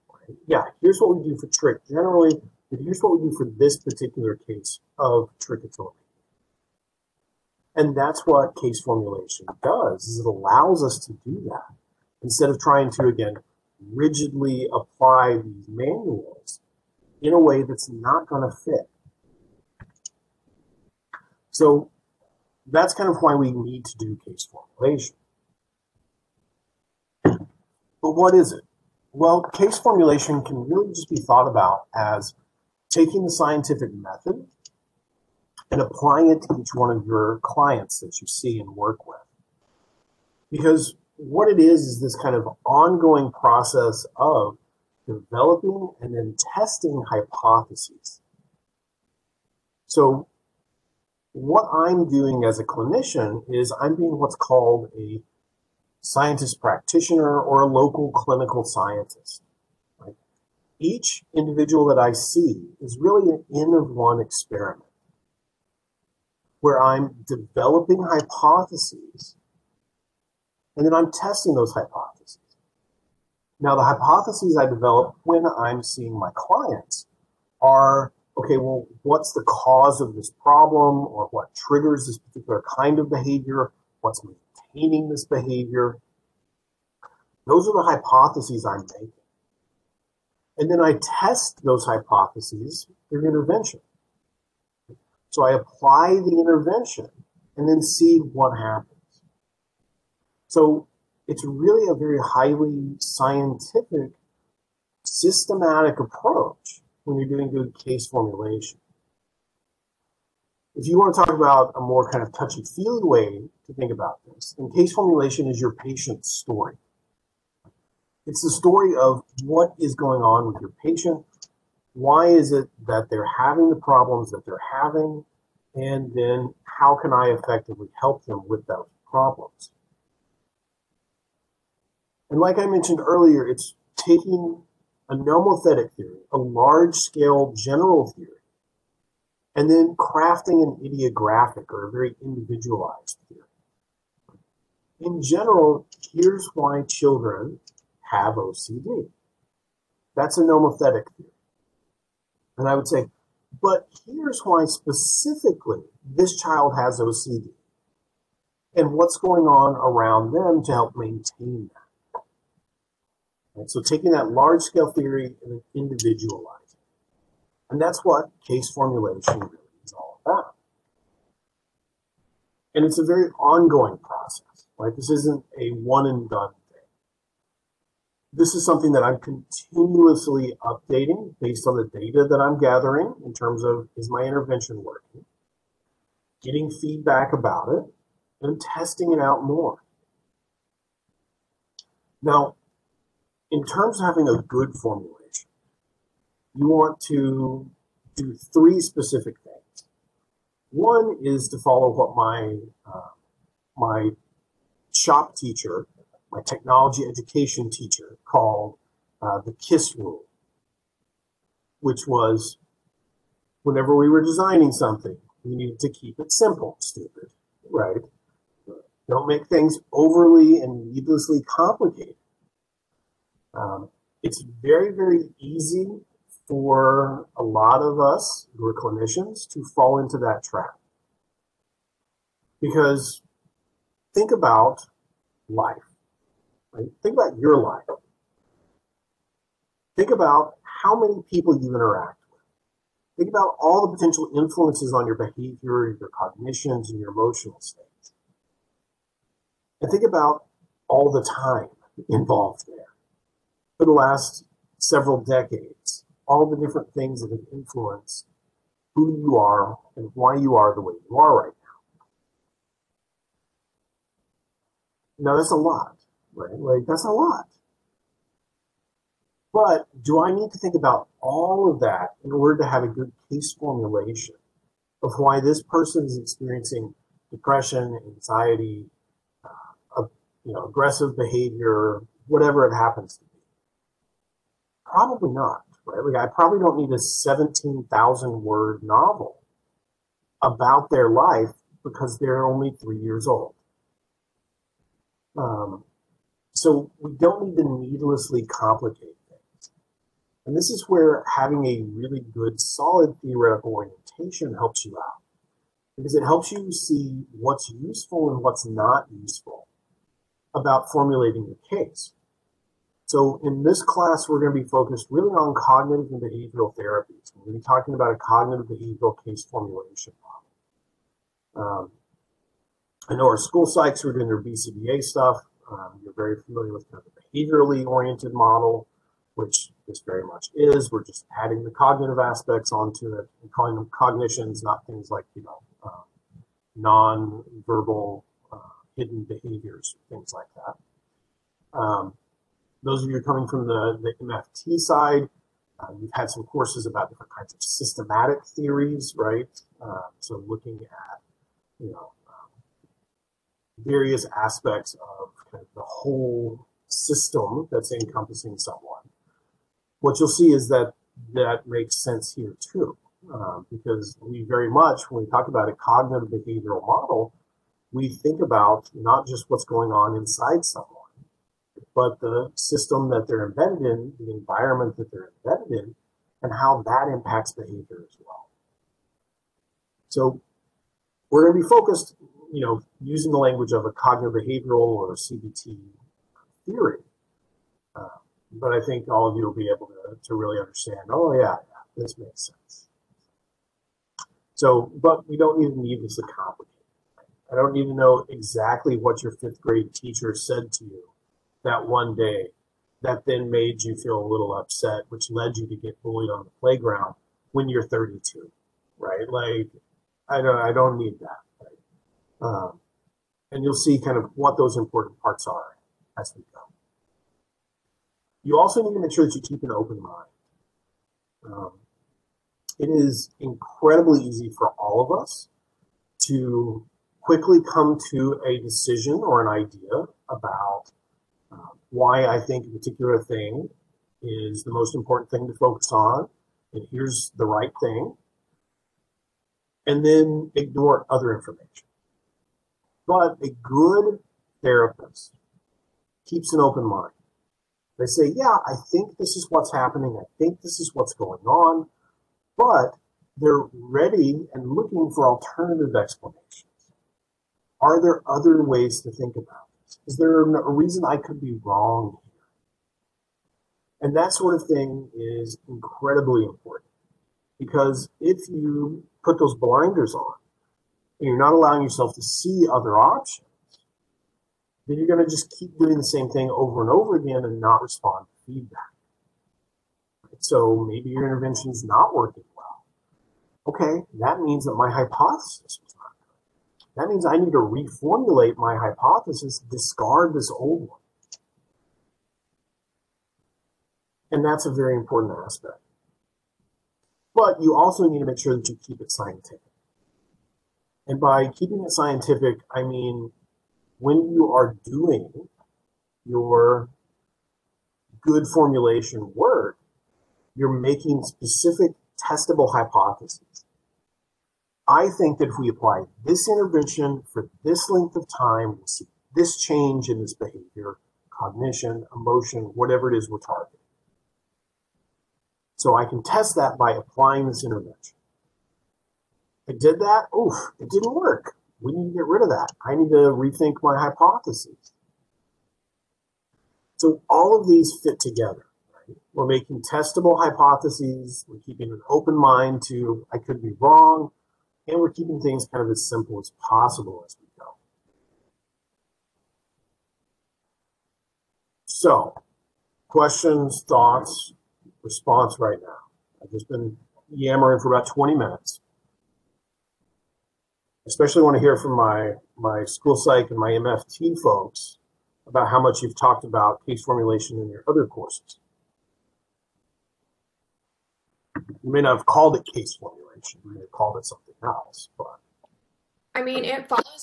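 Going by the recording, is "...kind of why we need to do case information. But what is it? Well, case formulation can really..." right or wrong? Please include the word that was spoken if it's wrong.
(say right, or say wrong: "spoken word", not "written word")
wrong: "formulation", not "information".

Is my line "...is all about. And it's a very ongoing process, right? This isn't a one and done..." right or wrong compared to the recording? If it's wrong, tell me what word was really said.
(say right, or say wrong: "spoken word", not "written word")
right.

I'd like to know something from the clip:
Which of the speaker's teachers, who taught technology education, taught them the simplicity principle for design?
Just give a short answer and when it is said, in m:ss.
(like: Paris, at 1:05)
Shop teacher, at 3:24.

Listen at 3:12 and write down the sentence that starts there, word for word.
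Now, in terms of having a good formulation, you want to do three specific things.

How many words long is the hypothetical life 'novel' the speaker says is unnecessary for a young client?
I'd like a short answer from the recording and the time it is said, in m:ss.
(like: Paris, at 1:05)
17,000, at 4:46.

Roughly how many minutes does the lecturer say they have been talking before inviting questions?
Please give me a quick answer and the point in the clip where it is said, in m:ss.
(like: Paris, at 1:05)
20, at 9:18.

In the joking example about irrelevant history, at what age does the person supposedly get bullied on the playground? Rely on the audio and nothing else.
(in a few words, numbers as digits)
32.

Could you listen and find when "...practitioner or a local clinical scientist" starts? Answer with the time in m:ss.
0:56.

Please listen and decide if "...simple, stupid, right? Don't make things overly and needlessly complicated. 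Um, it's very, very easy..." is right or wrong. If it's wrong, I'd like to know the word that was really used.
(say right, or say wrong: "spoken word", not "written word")
right.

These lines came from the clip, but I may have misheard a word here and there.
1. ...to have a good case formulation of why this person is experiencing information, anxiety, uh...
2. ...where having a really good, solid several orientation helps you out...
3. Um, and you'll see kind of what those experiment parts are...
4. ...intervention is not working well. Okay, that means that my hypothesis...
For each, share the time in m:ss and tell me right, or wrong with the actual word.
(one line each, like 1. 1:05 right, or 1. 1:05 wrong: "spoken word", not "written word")
1. 4:32 wrong: "depression", not "information"
2. 5:00 wrong: "theoretical", not "several"
3. 6:52 wrong: "important", not "experiment"
4. 8:01 right.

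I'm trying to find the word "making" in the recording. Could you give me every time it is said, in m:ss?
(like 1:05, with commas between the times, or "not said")
1:28, 8:30, 8:59.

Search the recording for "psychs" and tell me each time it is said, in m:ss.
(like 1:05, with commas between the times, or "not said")
5:23, 9:23.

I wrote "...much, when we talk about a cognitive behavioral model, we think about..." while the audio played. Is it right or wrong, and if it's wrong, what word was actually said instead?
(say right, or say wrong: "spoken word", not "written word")
right.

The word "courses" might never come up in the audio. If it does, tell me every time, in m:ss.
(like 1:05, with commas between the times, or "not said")
5:46, 9:28.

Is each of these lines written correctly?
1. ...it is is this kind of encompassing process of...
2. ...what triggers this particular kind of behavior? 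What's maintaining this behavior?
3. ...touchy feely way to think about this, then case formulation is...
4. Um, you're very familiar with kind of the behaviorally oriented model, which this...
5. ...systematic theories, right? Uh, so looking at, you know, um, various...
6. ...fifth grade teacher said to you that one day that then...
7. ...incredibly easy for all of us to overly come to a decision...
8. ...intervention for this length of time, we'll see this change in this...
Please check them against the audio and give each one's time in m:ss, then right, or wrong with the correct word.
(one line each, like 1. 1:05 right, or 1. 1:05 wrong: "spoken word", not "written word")
1. 0:41 wrong: "ongoing", not "encompassing"
2. 1:21 right
3. 1:52 right
4. 5:25 right
5. 5:47 right
6. 6:39 right
7. 7:03 wrong: "quickly", not "overly"
8. 8:36 right.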